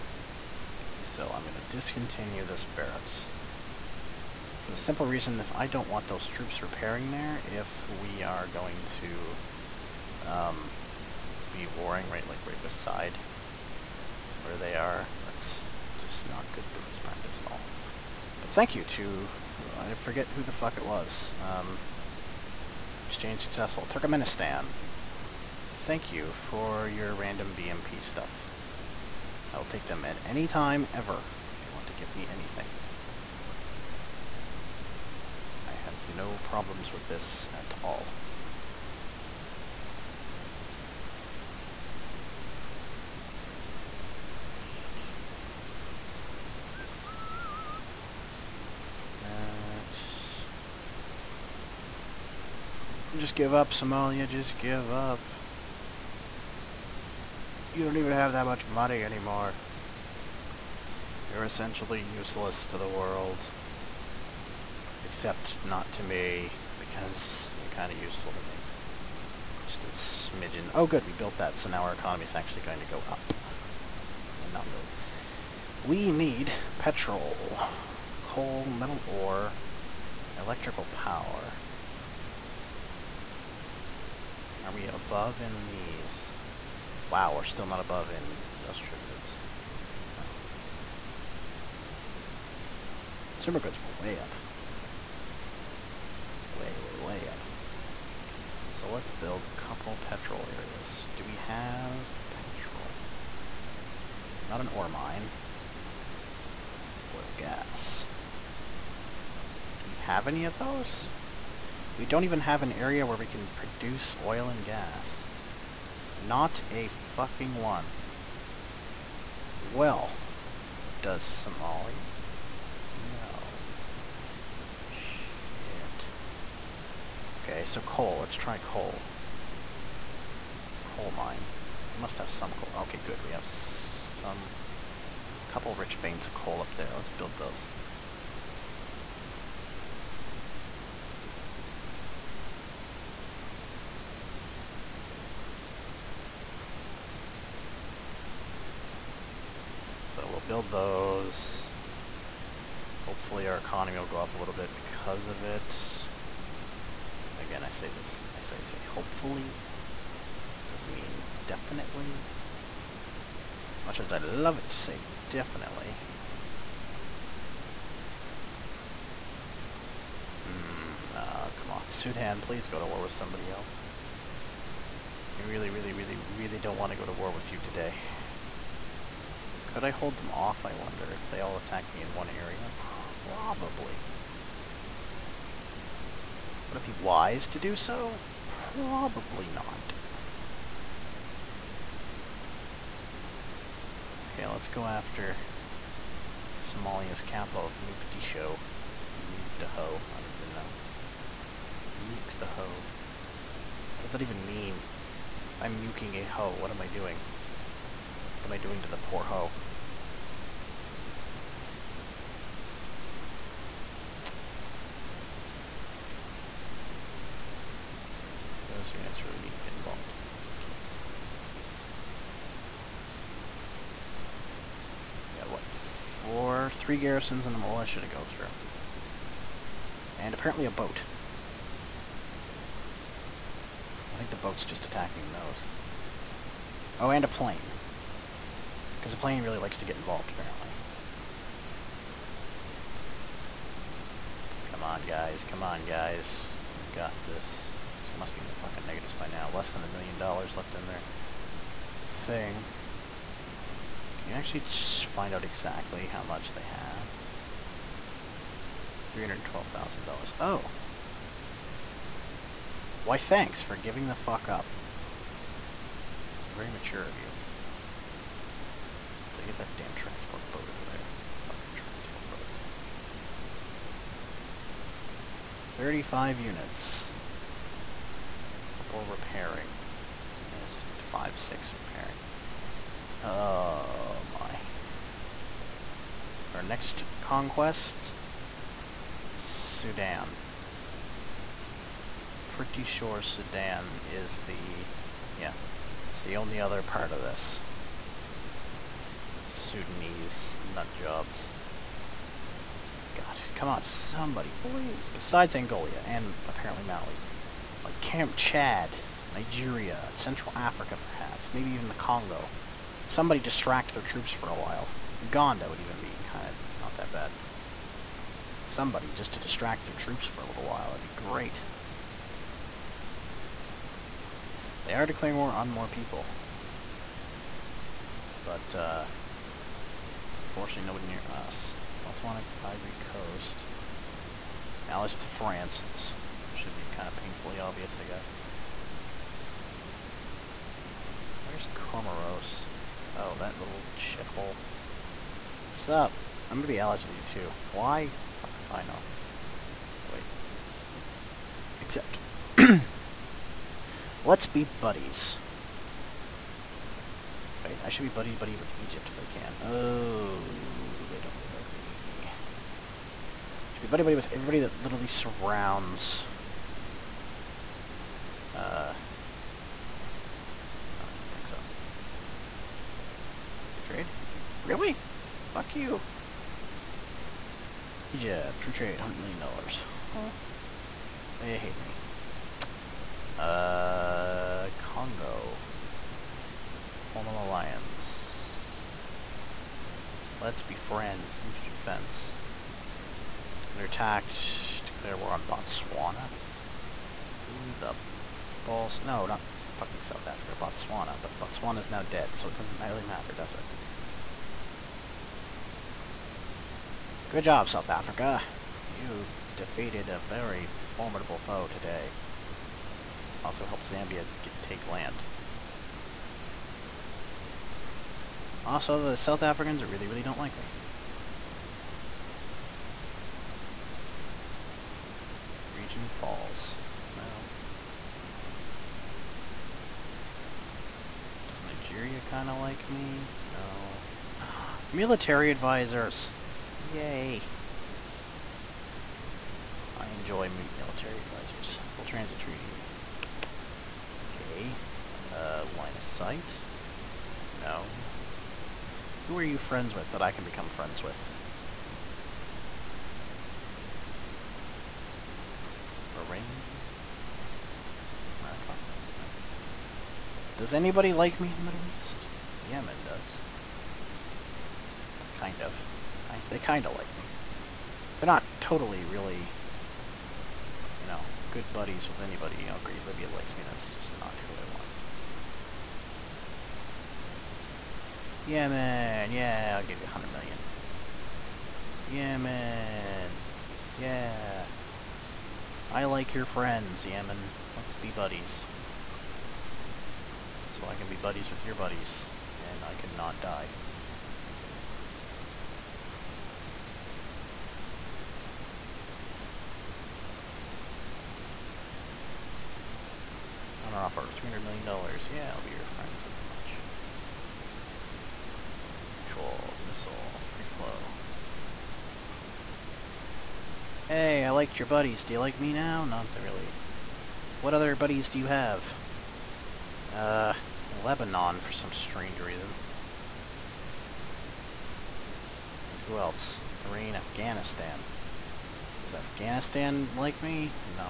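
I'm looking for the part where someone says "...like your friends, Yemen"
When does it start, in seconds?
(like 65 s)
486 s.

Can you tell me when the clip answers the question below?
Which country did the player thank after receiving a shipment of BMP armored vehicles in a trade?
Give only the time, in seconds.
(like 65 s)
23 s.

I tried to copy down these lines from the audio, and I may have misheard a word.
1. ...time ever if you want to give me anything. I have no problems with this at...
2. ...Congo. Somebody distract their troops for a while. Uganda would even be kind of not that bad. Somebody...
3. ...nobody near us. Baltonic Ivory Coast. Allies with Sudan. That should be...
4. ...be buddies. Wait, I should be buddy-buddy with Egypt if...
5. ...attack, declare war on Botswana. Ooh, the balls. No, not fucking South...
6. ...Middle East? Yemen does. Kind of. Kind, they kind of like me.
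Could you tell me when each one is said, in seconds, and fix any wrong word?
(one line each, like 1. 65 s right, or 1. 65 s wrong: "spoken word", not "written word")
1. 30 s right
2. 311 s right
3. 330 s wrong: "France", not "Sudan"
4. 354 s right
5. 393 s right
6. 461 s right.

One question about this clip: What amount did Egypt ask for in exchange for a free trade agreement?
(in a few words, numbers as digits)
$100 million.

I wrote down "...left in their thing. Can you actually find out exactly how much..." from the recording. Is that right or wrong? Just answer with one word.
right.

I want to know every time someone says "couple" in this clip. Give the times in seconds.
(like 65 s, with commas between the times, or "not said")
99 s, 135 s, 278 s.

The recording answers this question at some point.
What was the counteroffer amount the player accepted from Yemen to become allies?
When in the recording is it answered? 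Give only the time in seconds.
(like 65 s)
504 s.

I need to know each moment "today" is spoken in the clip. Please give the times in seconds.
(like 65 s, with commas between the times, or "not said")
177 s, 411 s.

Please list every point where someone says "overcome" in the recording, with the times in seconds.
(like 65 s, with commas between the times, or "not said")
not said.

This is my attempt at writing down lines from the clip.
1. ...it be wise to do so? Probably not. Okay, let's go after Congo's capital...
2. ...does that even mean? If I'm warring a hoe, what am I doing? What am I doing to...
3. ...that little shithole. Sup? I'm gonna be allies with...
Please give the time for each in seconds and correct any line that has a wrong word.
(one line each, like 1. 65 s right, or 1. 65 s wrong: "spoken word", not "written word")
1. 186 s wrong: "Somalia", not "Congo"
2. 204 s wrong: "muking", not "warring"
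3. 343 s right.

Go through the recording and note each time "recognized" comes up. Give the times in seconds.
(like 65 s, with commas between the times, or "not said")
not said.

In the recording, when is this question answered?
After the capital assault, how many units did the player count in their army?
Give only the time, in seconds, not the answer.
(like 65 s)
275 s.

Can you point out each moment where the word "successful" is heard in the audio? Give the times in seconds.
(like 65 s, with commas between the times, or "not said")
23 s.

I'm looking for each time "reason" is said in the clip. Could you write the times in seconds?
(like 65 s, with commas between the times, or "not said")
5 s, 522 s.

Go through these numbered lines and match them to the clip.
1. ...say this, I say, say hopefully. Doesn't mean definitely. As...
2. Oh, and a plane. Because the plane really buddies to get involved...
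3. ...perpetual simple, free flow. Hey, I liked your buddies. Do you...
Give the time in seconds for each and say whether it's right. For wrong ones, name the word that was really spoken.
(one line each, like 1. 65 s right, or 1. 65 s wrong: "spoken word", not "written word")
1. 157 s right
2. 236 s wrong: "likes", not "buddies"
3. 509 s wrong: "missile", not "simple".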